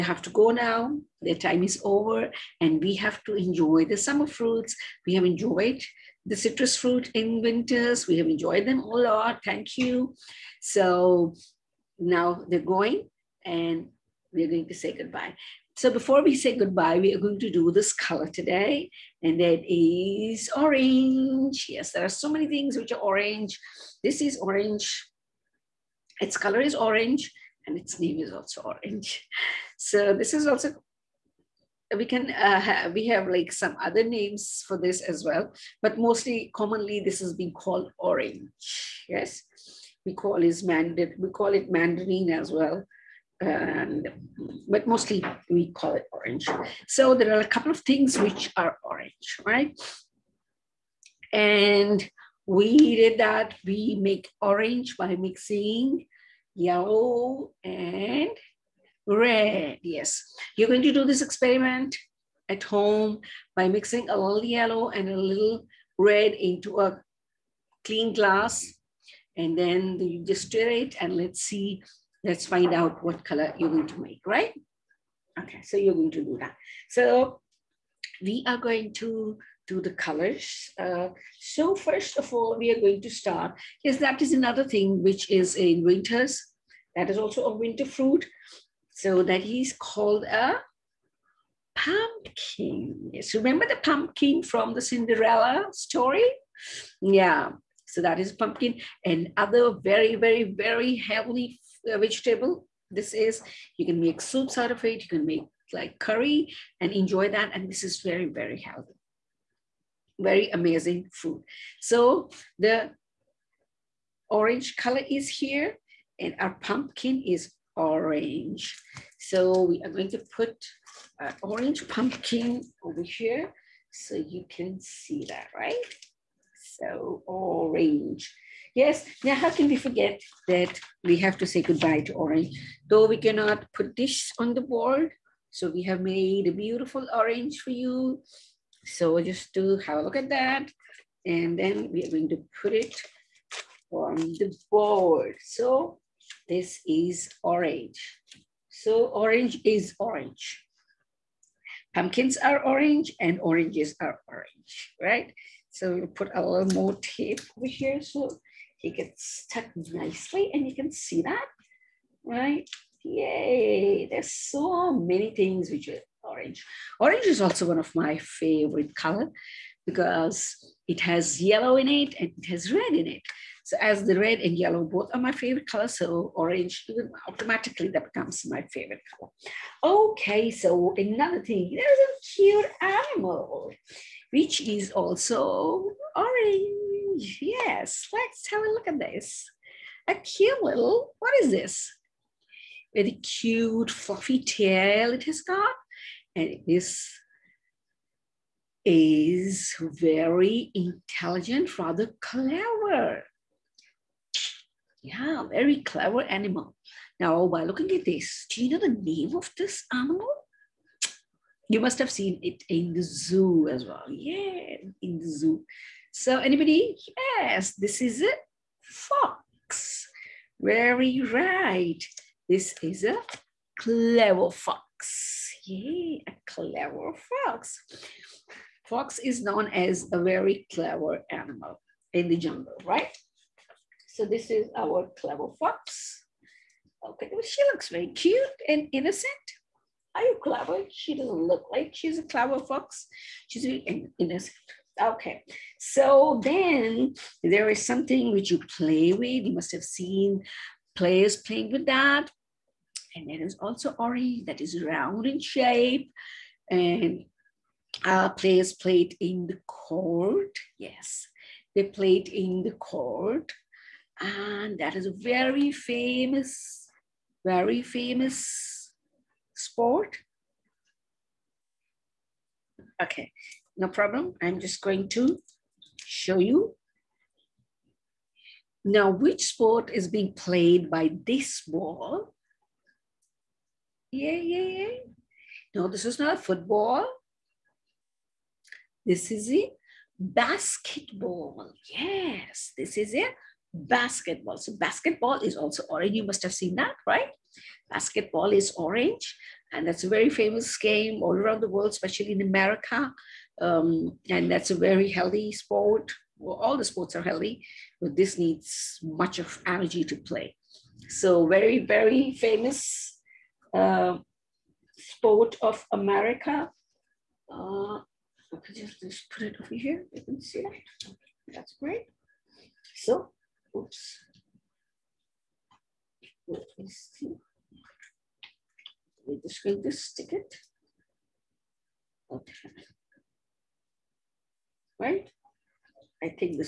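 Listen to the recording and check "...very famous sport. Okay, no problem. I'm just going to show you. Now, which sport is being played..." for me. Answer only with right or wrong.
right.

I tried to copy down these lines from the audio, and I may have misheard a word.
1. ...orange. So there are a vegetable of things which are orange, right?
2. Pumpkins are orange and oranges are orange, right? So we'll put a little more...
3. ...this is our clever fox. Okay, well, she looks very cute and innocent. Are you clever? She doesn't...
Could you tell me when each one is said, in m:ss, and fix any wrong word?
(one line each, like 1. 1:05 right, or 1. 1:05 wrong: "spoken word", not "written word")
1. 0:46 wrong: "couple", not "vegetable"
2. 2:31 right
3. 3:54 right.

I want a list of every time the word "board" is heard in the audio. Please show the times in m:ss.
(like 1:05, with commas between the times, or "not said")
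2:14, 2:24.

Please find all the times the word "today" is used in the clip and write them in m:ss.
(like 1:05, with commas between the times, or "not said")
0:18.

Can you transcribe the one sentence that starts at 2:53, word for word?
So as the red and yellow both are my favorite color, so orange automatically that becomes my favorite color.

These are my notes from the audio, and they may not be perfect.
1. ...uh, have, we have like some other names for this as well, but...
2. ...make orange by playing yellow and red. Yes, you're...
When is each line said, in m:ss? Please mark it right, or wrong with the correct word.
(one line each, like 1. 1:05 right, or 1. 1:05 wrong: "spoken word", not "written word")
1. 0:32 right
2. 0:53 wrong: "mixing", not "playing".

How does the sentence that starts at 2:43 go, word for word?
Yay, there's so many things which are orange.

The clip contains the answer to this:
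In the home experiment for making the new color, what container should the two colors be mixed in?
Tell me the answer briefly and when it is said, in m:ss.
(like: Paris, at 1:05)
a clean glass, at 1:07.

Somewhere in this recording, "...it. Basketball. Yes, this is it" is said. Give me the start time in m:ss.
4:49.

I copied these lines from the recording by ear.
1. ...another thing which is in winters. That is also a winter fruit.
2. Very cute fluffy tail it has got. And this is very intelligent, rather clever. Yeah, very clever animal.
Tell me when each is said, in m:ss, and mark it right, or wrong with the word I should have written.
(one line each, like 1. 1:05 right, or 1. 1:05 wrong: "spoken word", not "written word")
1. 1:24 right
2. 3:12 right.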